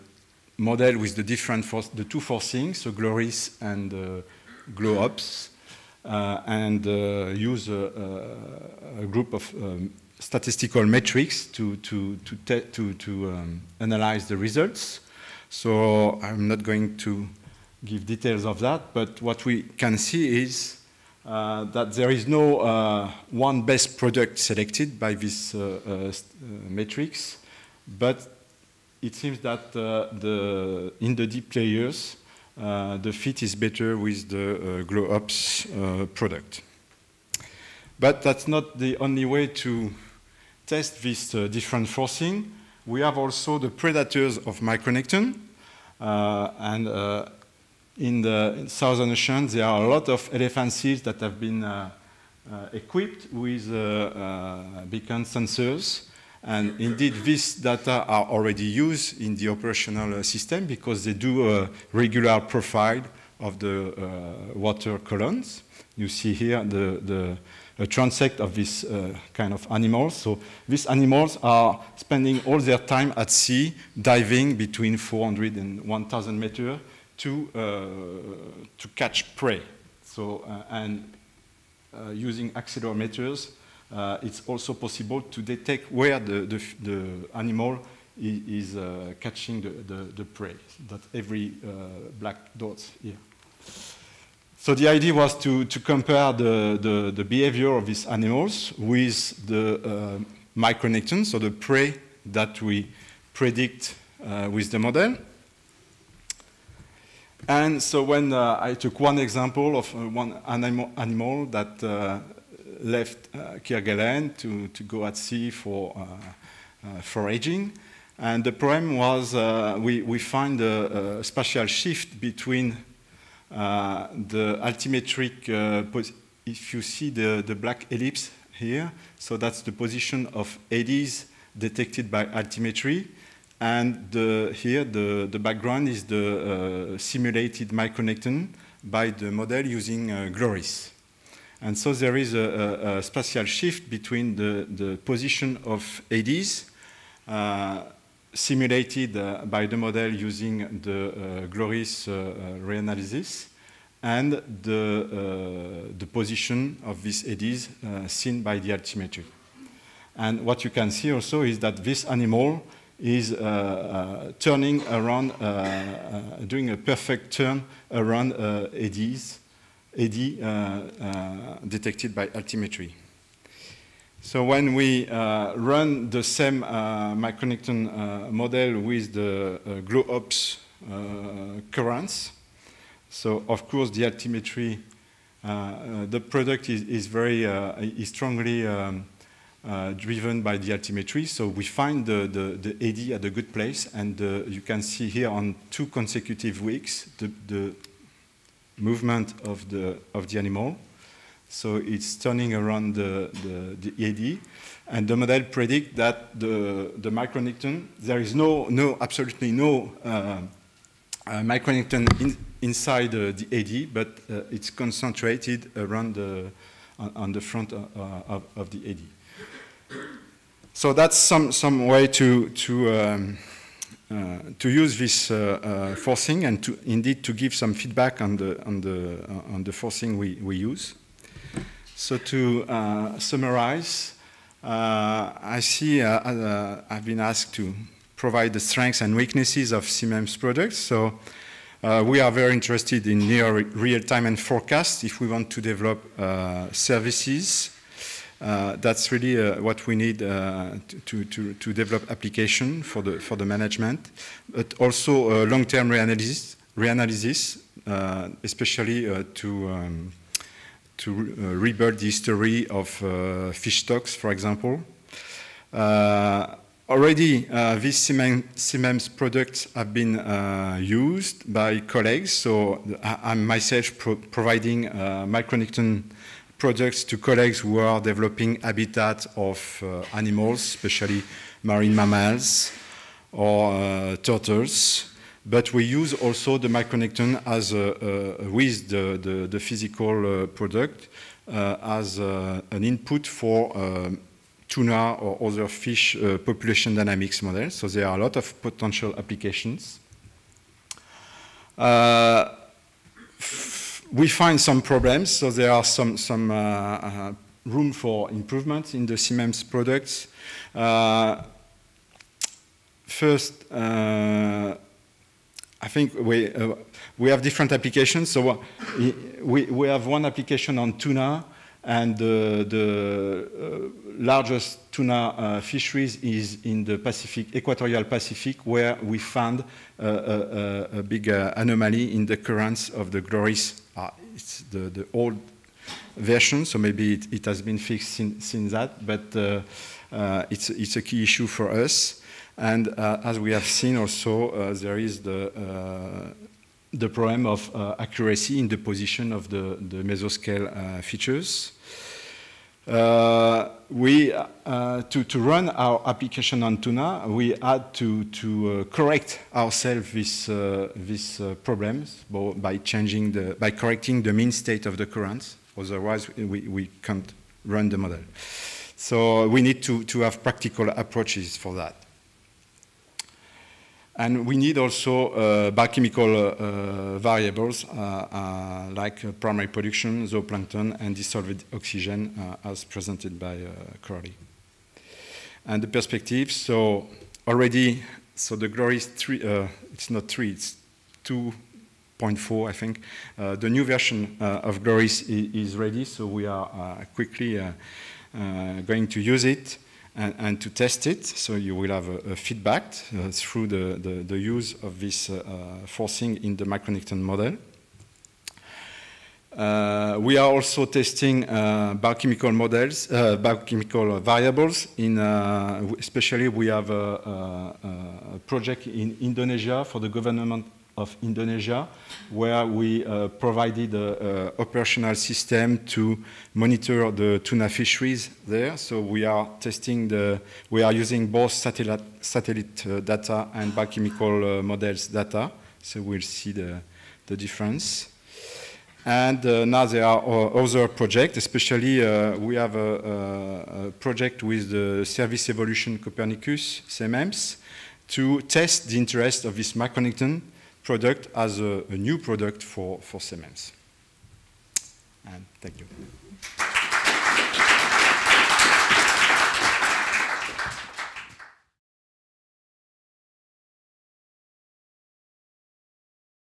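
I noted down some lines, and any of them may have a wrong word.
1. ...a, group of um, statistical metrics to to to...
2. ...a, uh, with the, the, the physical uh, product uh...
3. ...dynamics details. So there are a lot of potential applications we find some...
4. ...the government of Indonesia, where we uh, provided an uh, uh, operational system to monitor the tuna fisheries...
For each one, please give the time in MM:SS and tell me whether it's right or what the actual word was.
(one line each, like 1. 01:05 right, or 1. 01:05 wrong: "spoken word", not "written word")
1. 00:09 right
2. 04:47 right
3. 04:56 wrong: "models", not "details"
4. 06:59 right.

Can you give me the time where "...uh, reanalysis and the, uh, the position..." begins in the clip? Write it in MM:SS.
02:32.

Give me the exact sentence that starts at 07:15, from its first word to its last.
So we'll see the, the difference.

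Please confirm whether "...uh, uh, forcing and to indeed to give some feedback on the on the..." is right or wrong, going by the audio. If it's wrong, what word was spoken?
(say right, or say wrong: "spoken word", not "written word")
right.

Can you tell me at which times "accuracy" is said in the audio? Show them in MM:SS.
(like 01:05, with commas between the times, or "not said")
05:47.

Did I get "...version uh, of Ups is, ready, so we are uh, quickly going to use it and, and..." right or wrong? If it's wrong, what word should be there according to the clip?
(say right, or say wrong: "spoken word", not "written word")
wrong: "GLORYS", not "Ups".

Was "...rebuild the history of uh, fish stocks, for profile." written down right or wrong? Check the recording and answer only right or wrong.
wrong.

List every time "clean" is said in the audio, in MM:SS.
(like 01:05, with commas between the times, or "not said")
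not said.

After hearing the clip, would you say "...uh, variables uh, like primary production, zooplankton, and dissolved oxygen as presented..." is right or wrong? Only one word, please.
right.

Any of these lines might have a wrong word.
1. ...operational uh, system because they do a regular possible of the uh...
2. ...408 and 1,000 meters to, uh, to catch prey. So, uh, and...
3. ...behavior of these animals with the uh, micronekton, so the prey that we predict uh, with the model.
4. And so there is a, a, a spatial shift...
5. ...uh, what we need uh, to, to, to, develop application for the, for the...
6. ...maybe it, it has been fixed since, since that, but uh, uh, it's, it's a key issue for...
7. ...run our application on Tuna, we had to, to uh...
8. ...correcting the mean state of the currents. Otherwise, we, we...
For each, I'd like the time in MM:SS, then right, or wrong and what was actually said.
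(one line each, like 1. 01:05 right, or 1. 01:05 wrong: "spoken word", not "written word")
1. 00:59 wrong: "profile", not "possible"
2. 01:14 wrong: "400", not "408"
3. 01:37 right
4. 02:21 right
5. 04:09 right
6. 05:36 right
7. 05:55 right
8. 06:03 right.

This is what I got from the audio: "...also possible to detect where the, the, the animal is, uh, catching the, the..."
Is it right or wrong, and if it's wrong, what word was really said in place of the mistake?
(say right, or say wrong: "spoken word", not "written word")
right.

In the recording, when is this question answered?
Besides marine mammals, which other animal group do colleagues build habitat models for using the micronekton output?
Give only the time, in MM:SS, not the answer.
04:44.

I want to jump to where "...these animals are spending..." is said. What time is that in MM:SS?
01:10.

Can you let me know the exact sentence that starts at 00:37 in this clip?
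But that's not the only way to test this different forcing.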